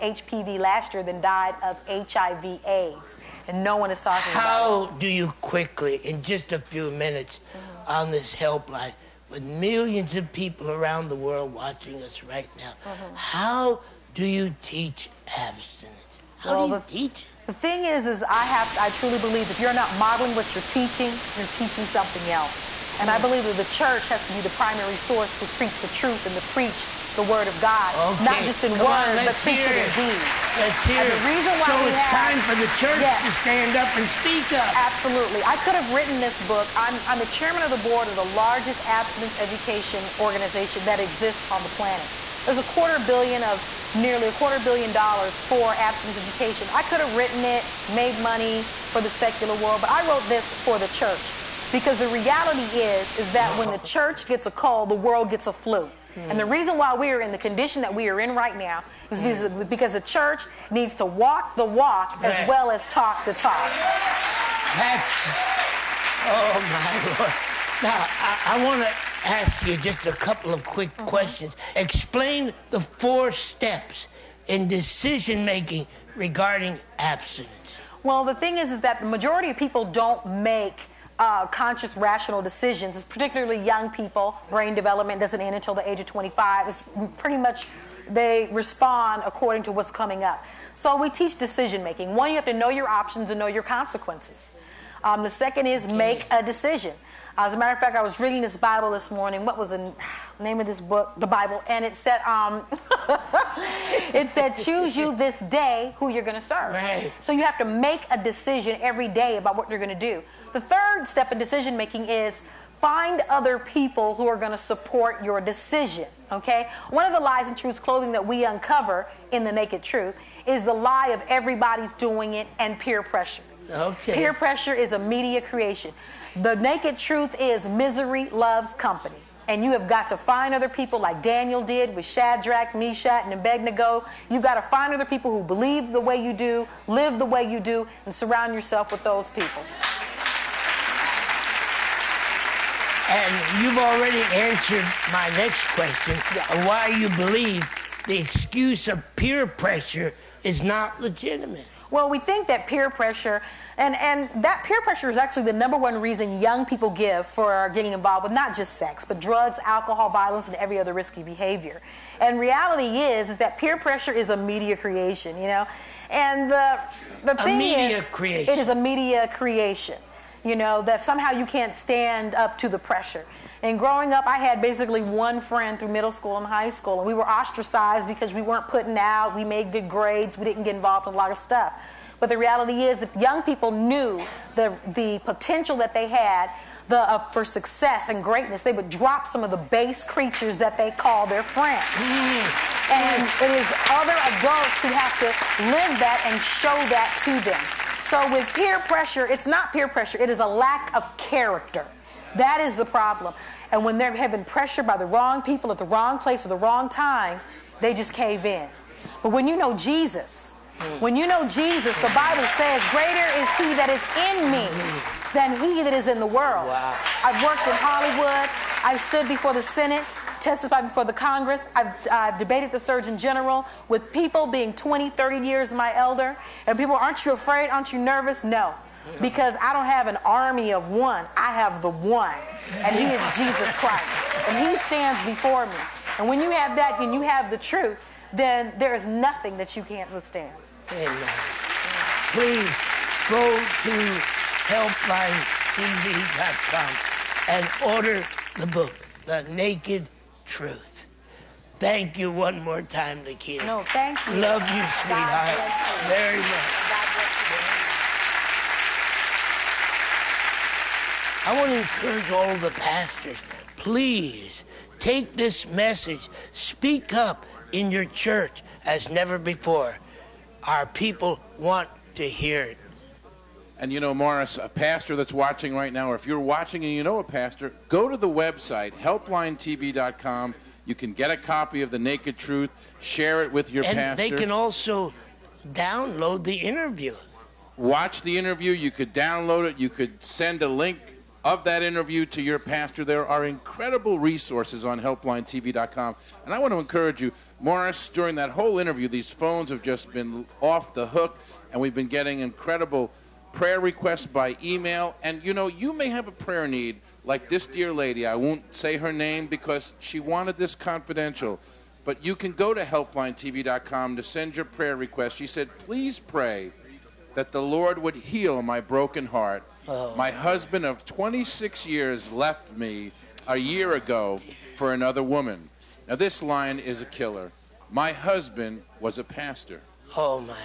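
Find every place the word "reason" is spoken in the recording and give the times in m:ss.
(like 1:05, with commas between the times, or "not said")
0:31, 0:56, 2:36.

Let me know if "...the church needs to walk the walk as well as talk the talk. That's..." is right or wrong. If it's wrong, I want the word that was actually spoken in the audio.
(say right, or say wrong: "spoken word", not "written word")
right.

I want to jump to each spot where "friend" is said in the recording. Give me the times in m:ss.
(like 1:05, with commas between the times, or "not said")
2:55, 3:11.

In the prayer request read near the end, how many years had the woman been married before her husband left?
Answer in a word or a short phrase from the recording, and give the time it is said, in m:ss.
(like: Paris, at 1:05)
26, at 5:21.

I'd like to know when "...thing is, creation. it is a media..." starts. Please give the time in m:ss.
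2:47.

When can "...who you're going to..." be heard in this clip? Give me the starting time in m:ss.
1:45.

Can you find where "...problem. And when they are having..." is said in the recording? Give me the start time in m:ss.
3:22.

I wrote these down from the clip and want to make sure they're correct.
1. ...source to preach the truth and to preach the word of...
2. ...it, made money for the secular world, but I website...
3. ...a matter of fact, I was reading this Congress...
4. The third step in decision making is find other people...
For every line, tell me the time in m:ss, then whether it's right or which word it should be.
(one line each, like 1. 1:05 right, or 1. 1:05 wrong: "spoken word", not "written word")
1. 0:24 right
2. 0:47 wrong: "wrote", not "website"
3. 1:37 wrong: "Bible", not "Congress"
4. 1:50 right.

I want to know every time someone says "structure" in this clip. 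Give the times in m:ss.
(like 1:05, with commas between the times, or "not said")
not said.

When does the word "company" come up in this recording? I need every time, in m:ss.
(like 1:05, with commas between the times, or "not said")
2:08.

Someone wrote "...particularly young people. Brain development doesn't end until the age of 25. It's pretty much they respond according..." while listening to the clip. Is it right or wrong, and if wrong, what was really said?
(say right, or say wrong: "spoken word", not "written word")
right.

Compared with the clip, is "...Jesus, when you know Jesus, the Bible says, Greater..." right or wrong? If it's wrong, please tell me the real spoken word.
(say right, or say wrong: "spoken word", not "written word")
right.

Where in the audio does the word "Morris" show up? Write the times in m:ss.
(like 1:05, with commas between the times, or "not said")
4:34, 4:57.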